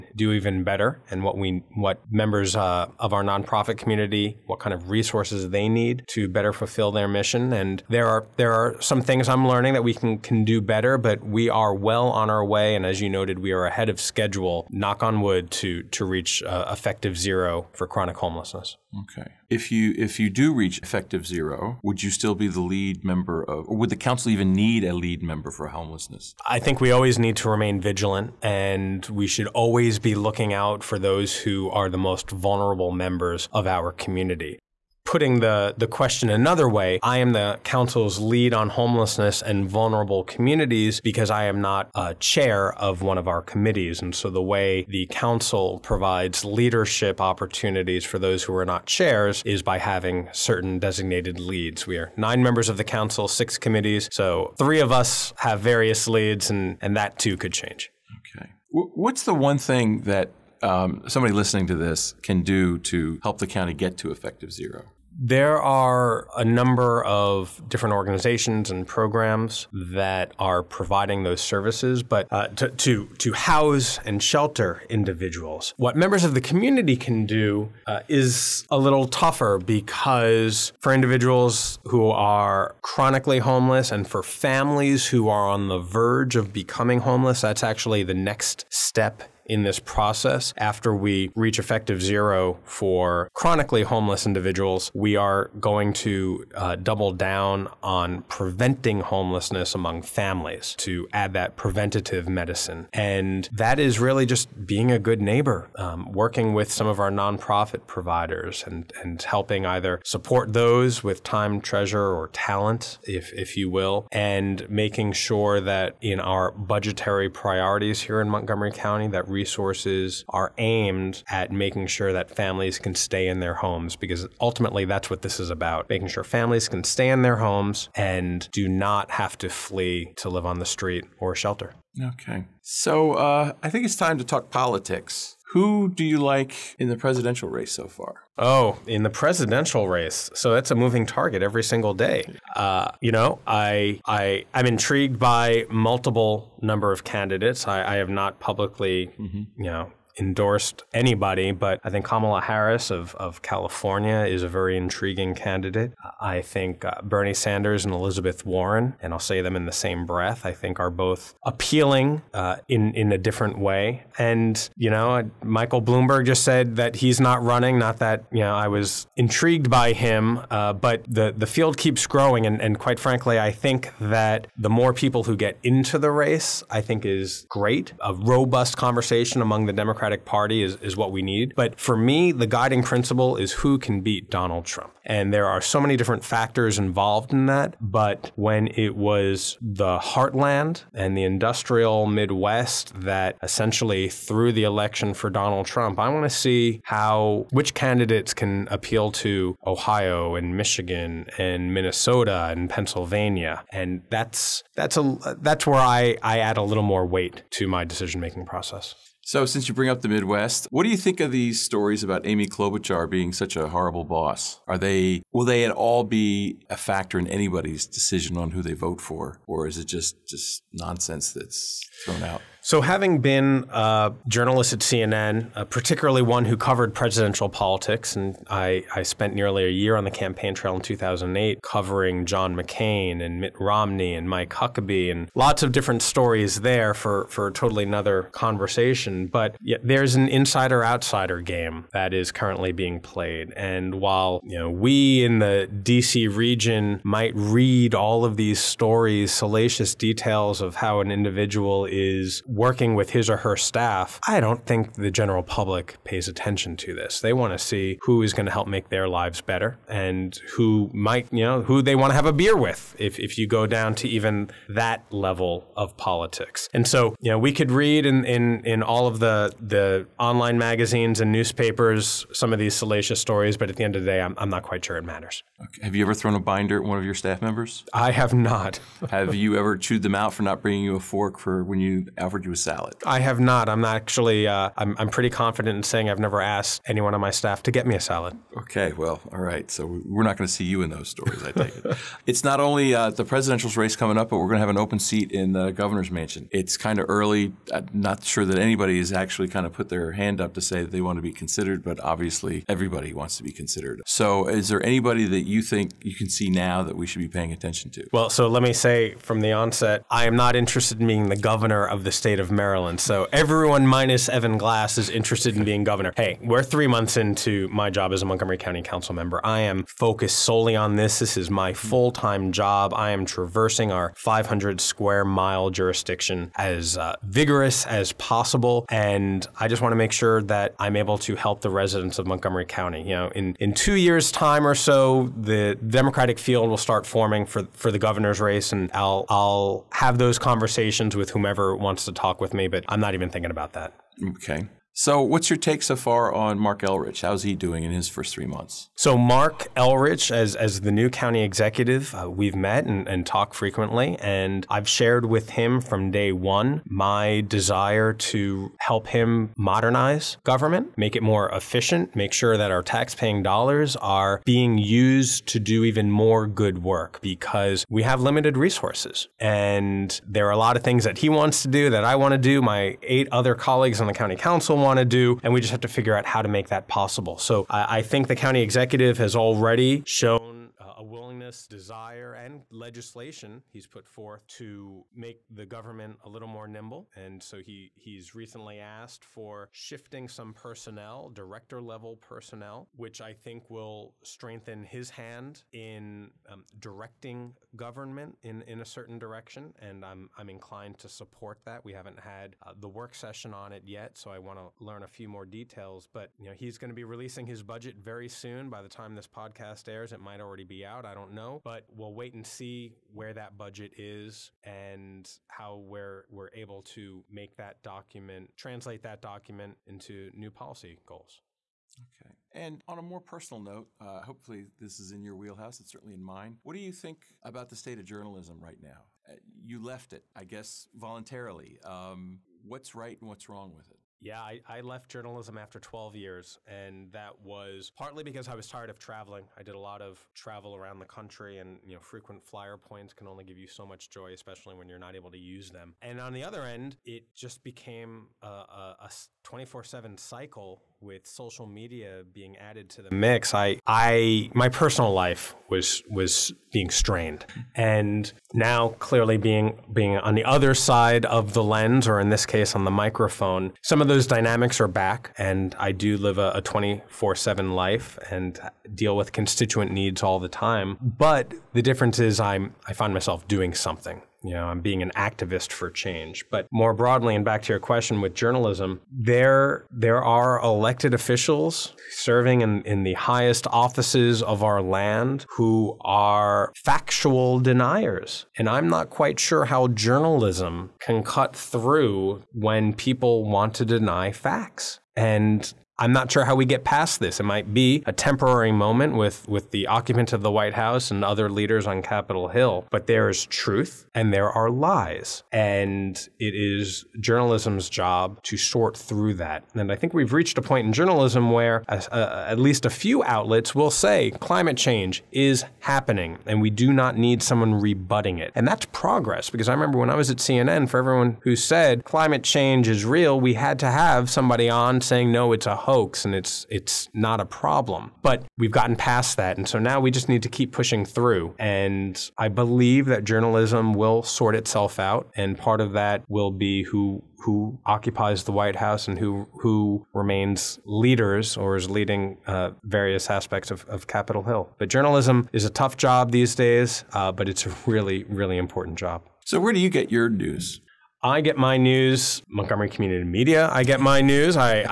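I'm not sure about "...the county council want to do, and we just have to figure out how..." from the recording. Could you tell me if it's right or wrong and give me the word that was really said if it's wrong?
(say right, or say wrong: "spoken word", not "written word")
right.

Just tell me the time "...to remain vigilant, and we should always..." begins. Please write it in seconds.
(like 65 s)
27 s.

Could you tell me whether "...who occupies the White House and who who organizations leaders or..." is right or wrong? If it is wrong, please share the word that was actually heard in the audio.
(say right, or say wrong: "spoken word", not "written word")
wrong: "remains", not "organizations".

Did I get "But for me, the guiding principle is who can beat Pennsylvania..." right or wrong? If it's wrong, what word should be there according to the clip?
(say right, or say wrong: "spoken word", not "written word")
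wrong: "Donald", not "Pennsylvania".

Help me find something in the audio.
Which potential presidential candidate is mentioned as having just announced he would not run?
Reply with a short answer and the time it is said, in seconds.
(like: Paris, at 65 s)
Michael Bloomberg, at 165 s.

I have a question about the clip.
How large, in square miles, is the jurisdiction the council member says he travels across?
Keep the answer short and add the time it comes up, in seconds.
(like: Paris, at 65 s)
500 square miles, at 324 s.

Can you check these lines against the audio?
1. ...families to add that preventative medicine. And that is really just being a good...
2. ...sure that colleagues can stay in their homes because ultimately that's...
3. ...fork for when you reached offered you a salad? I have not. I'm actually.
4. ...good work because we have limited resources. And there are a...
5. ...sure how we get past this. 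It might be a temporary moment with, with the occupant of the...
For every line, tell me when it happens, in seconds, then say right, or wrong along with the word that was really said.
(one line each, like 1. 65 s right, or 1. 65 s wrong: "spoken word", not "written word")
1. 100 s right
2. 121 s wrong: "families", not "colleagues"
3. 280 s wrong: "offered", not "reached"
4. 366 s right
5. 496 s right.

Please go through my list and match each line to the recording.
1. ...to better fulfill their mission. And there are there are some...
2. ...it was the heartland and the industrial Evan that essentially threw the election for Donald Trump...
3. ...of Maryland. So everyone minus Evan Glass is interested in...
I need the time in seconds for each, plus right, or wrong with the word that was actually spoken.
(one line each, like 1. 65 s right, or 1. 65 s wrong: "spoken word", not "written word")
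1. 6 s right
2. 188 s wrong: "Midwest", not "Evan"
3. 312 s right.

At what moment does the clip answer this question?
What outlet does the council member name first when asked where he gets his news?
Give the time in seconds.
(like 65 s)
552 s.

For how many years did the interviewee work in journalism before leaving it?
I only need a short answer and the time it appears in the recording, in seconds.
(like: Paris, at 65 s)
12, at 435 s.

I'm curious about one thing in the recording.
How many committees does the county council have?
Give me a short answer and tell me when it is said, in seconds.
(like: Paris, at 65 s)
6, at 53 s.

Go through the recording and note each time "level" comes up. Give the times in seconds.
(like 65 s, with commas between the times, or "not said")
265 s, 391 s.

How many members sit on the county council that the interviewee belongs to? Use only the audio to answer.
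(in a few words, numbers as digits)
9.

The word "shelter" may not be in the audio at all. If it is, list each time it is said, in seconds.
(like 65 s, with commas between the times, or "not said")
74 s, 131 s.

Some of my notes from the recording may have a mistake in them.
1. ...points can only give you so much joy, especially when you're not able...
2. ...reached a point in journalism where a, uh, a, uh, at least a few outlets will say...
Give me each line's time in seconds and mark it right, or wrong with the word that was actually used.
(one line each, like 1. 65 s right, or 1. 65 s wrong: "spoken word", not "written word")
1. 442 s right
2. 510 s right.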